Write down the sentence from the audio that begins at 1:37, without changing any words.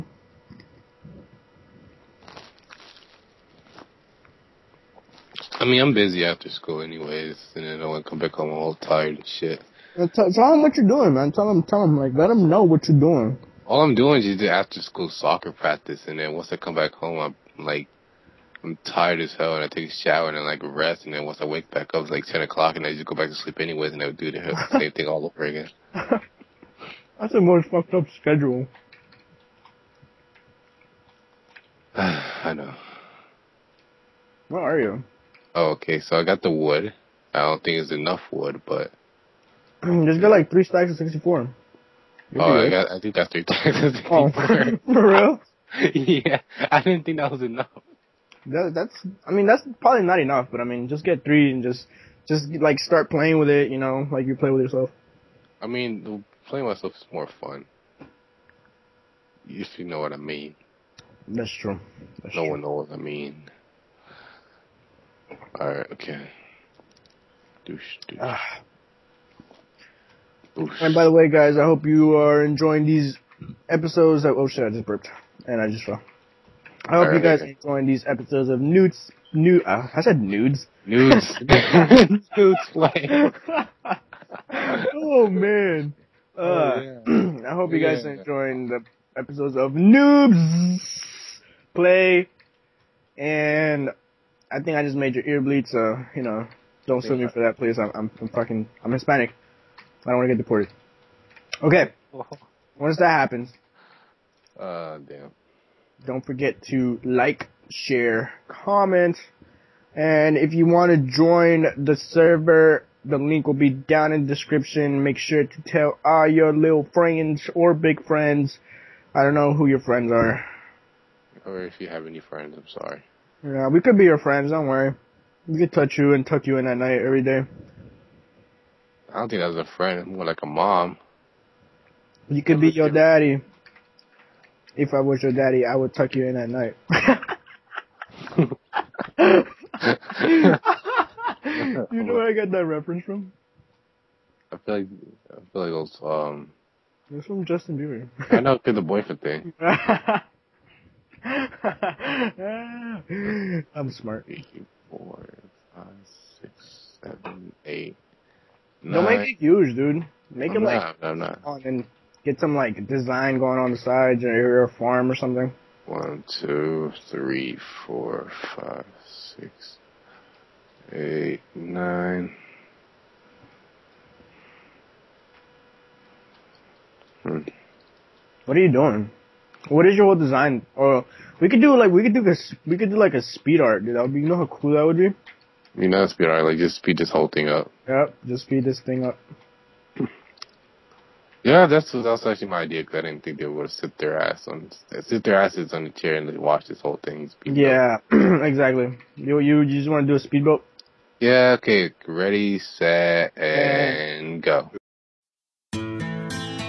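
I'm, I'm, I'm fucking, I'm Hispanic.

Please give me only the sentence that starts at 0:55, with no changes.
I mean, playing myself is more fun.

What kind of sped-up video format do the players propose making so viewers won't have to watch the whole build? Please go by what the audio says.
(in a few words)
Speed art.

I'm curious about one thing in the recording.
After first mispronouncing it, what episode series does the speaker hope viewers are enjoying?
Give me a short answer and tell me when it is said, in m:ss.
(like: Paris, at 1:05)
Noobs Play, at 1:29.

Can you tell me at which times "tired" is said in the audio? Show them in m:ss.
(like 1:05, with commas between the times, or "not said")
0:08, 0:18.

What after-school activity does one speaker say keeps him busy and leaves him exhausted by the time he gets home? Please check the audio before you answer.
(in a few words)
Soccer practice.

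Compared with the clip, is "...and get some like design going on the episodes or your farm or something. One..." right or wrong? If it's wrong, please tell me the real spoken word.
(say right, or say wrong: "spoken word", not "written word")
wrong: "sides", not "episodes".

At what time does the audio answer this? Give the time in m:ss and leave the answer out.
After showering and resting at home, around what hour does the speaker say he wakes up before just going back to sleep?
0:22.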